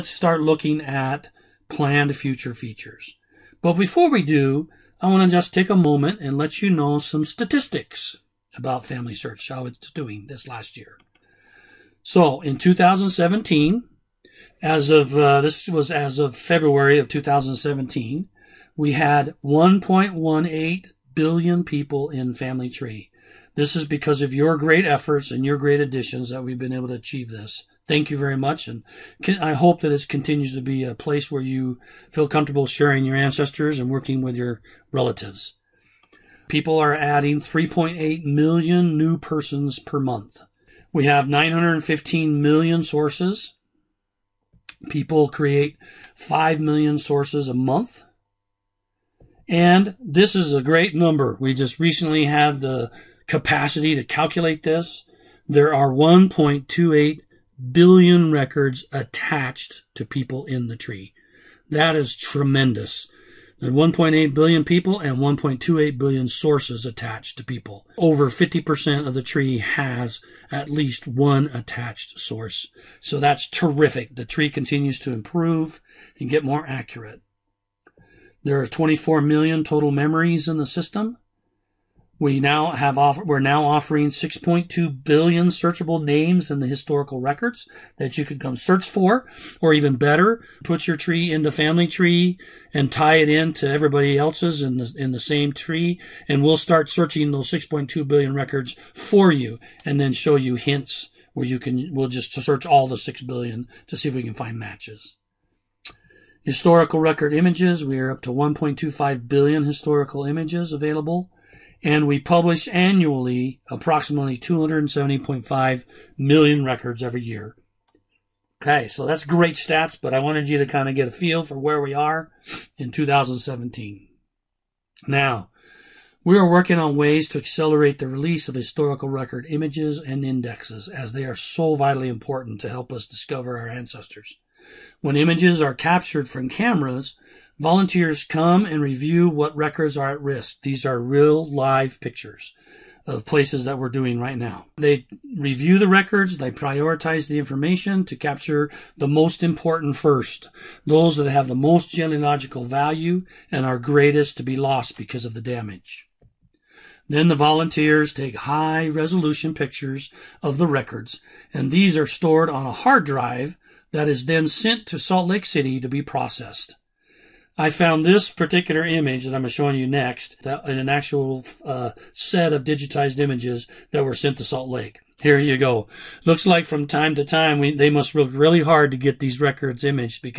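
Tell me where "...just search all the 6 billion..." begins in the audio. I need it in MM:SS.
01:42.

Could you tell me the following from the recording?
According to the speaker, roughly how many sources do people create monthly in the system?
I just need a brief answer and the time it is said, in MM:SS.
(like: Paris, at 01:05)
5 million, at 00:46.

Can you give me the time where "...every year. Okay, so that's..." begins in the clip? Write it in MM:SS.
01:57.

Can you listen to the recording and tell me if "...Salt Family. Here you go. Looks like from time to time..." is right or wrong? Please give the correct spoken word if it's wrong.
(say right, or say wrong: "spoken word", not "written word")
wrong: "Lake", not "Family".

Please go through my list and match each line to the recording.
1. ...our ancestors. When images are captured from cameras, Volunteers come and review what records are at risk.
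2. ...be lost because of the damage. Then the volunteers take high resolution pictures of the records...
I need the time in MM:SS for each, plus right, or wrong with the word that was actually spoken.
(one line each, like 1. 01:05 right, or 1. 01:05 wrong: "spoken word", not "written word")
1. 02:13 right
2. 02:34 right.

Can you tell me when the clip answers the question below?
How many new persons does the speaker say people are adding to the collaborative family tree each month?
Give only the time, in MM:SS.
00:37.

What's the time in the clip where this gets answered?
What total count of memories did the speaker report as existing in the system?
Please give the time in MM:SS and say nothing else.
01:18.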